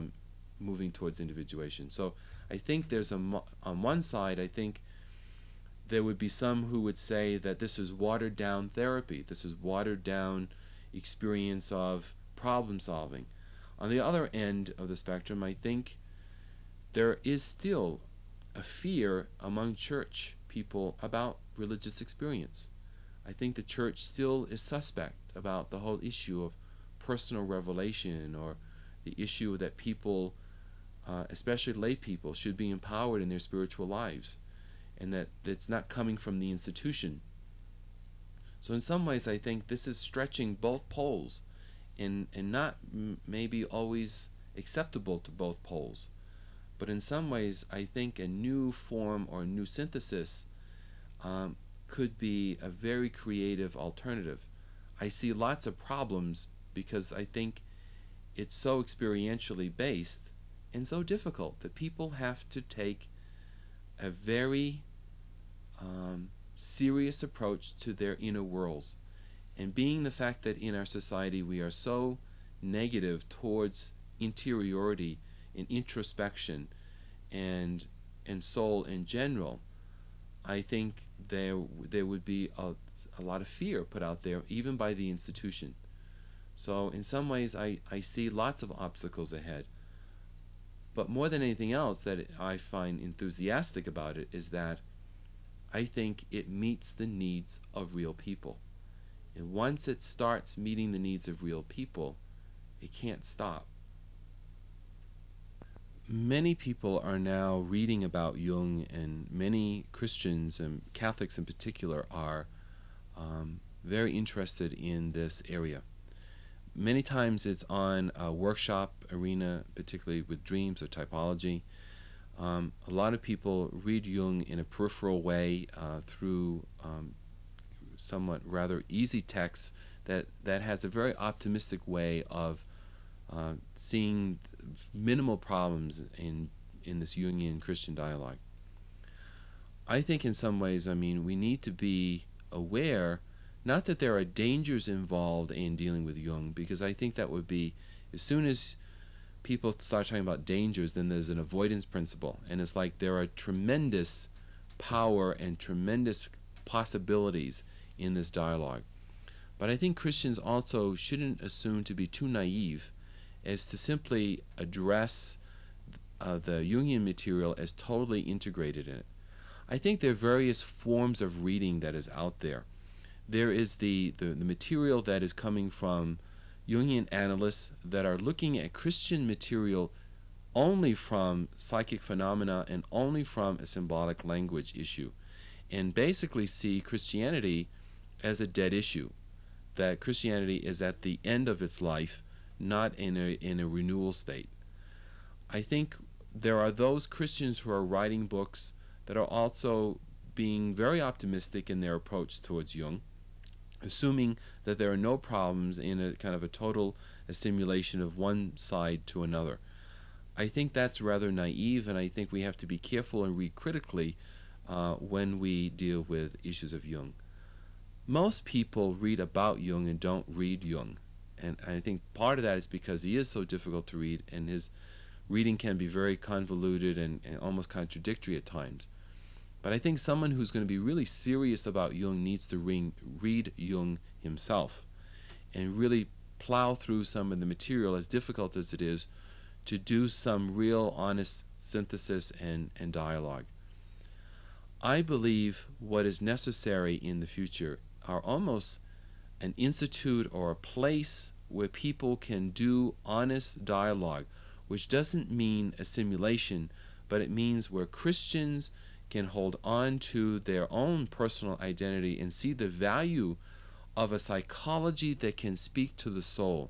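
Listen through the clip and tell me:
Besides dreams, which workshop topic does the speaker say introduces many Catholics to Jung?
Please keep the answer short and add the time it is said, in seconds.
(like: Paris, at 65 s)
typology, at 120 s.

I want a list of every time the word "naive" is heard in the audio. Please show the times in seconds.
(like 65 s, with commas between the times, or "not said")
162 s, 211 s.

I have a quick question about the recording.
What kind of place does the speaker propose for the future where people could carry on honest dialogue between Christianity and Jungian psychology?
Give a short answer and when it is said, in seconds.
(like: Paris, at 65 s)
an institute, at 249 s.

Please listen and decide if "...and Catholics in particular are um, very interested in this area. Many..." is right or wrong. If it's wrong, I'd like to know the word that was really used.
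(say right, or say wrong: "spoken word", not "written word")
right.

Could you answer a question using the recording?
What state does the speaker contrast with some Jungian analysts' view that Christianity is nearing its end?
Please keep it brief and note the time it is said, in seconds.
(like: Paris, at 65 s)
renewal state, at 193 s.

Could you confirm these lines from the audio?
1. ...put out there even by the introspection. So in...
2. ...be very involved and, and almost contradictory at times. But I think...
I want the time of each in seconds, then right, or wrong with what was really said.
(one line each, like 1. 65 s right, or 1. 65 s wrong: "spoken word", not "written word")
1. 83 s wrong: "institution", not "introspection"
2. 225 s wrong: "convoluted", not "involved".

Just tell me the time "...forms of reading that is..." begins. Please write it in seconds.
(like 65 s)
170 s.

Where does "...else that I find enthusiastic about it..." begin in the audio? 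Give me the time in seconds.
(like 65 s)
91 s.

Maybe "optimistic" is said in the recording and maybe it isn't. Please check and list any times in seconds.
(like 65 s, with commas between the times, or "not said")
131 s, 201 s.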